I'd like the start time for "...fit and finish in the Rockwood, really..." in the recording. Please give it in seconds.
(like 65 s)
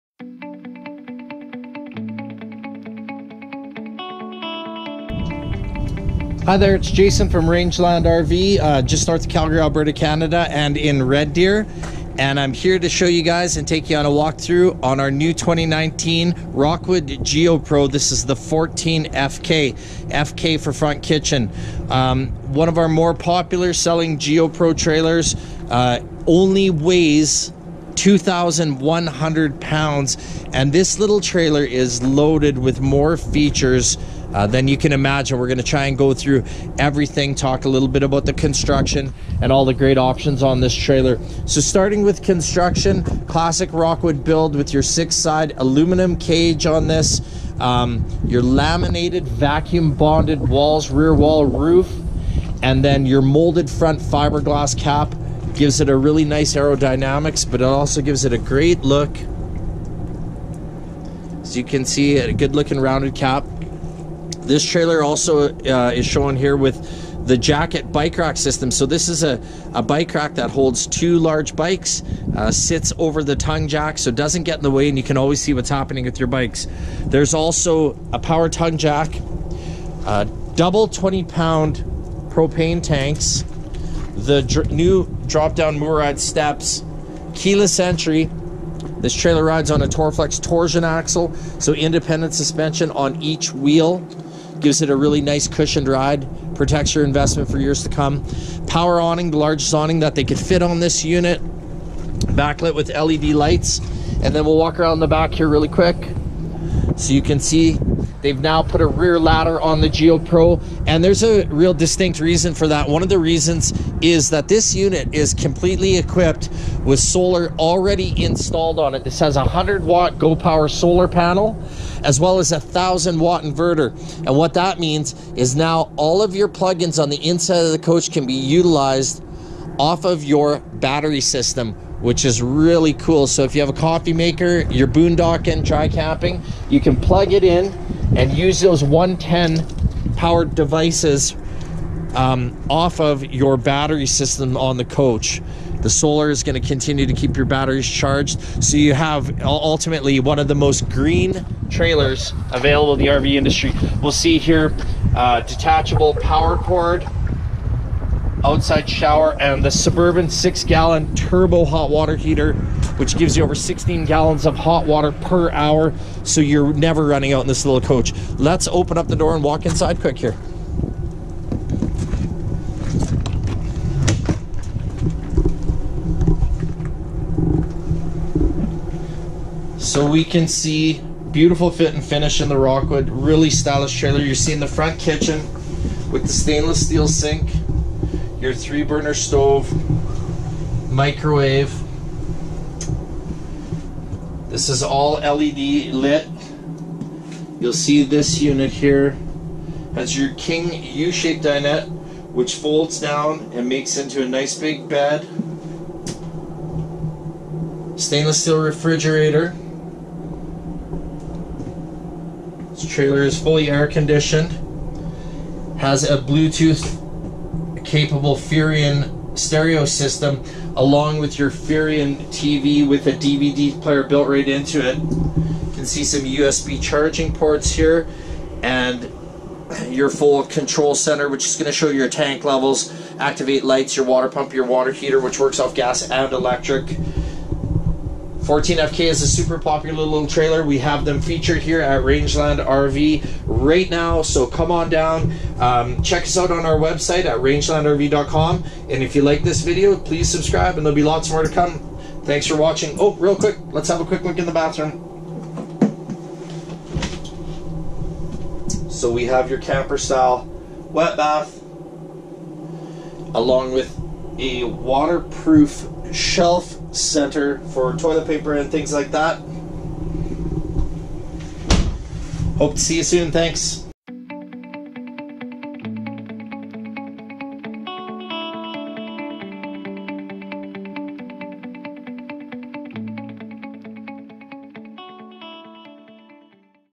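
181 s.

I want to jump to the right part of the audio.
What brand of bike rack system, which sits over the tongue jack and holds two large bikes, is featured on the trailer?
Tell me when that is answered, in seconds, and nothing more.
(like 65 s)
67 s.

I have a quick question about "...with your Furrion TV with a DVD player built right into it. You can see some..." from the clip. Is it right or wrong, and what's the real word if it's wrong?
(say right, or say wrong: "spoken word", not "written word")
right.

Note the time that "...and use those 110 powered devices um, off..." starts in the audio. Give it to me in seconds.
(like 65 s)
138 s.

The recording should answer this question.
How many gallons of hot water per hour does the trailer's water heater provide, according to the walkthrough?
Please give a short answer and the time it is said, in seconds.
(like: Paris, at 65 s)
16 gallons, at 163 s.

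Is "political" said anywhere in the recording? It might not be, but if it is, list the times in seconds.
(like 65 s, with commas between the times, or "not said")
not said.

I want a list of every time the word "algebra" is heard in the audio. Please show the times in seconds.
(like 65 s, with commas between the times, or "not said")
not said.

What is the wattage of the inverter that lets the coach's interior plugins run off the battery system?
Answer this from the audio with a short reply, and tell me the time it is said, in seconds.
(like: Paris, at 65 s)
1000 watt, at 122 s.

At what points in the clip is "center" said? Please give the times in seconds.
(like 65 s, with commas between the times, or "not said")
230 s, 266 s.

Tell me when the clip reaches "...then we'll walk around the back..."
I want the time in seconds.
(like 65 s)
104 s.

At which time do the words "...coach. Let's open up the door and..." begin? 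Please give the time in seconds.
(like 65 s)
167 s.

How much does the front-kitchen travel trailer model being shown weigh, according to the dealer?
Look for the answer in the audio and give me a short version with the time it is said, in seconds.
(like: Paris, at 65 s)
2,100 pounds, at 27 s.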